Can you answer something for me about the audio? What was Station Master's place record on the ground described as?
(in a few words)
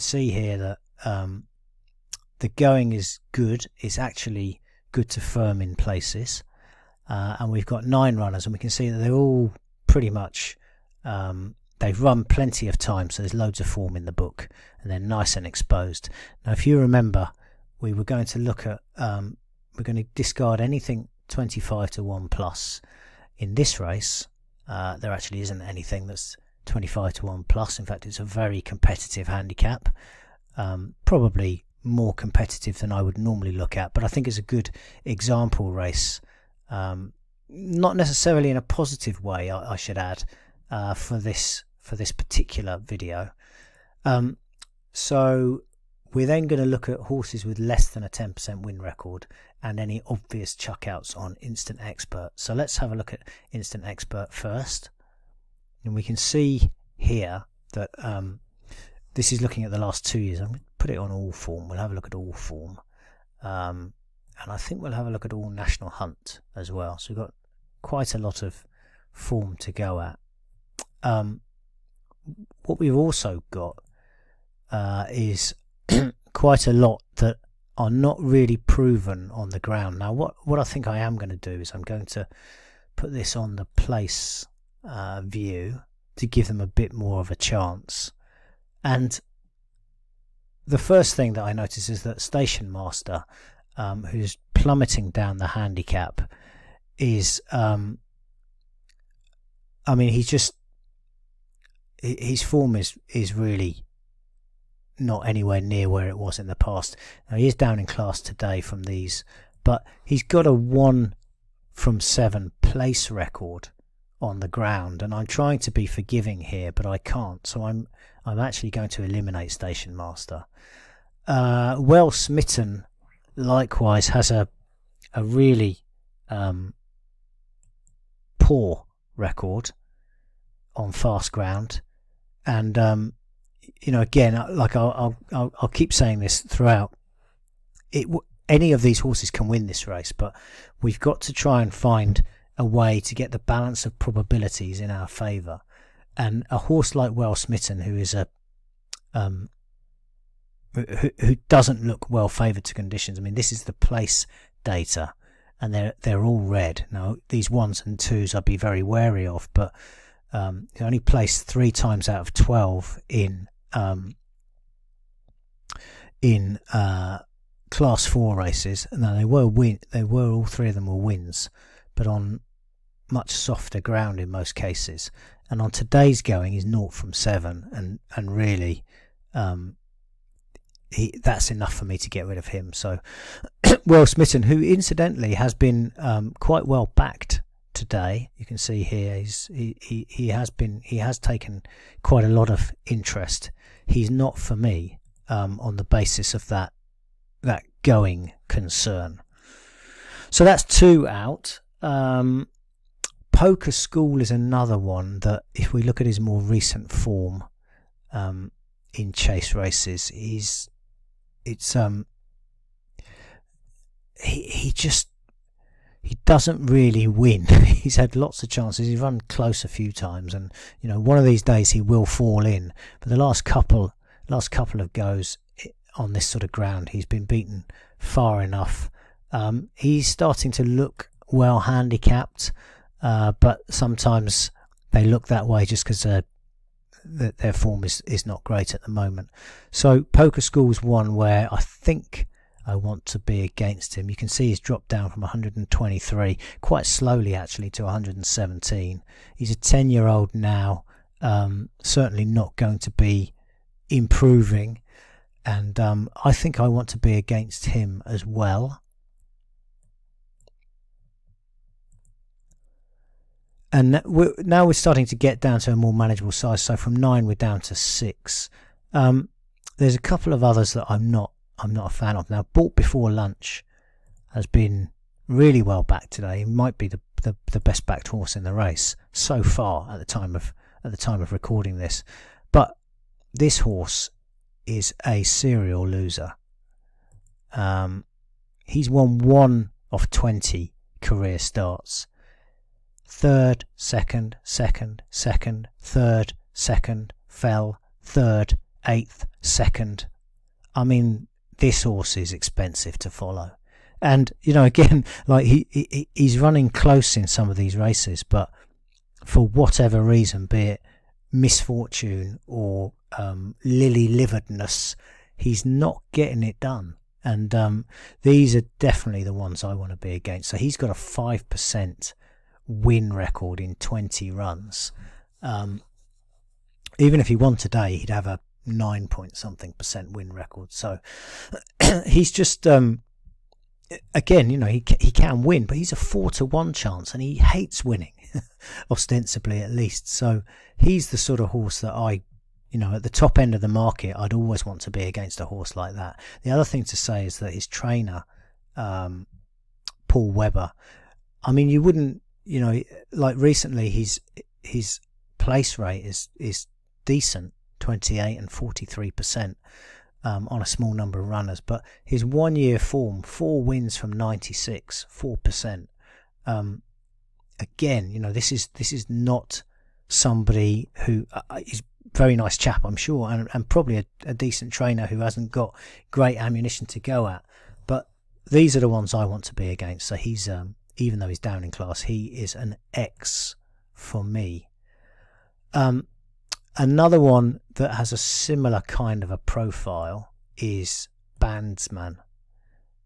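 1 from 7.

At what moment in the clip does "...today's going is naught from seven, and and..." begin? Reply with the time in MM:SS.
02:55.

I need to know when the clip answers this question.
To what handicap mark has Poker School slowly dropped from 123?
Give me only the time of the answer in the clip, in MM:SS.
04:07.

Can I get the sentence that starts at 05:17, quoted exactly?
And um, these are definitely the ones I want to be against.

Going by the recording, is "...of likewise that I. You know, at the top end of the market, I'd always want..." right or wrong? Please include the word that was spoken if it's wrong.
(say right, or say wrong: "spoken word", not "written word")
wrong: "horse", not "likewise".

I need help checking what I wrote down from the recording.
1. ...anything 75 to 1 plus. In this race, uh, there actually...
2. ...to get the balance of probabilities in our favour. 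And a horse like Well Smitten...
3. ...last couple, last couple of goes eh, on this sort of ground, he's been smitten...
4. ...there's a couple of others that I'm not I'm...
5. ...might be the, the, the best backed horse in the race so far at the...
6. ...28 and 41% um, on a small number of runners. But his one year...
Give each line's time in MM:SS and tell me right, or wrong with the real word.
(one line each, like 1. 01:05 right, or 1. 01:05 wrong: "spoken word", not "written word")
1. 00:20 wrong: "25", not "75"
2. 02:22 right
3. 03:43 wrong: "beaten", not "smitten"
4. 04:29 right
5. 04:36 right
6. 05:57 wrong: "43", not "41".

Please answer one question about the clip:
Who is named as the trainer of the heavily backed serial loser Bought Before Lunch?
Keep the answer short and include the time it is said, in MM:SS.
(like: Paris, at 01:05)
Paul Weber, at 05:50.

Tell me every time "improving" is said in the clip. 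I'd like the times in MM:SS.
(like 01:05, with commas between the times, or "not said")
04:13.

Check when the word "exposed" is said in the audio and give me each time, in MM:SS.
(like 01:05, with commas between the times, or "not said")
00:15.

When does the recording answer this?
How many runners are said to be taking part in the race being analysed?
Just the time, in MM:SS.
00:07.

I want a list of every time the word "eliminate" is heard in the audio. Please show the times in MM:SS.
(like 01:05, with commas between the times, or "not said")
01:59.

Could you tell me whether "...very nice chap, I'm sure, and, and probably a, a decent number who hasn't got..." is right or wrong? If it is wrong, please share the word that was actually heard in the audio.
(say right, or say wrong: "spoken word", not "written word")
wrong: "trainer", not "number".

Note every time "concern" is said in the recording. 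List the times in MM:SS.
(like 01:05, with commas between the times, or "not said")
03:18.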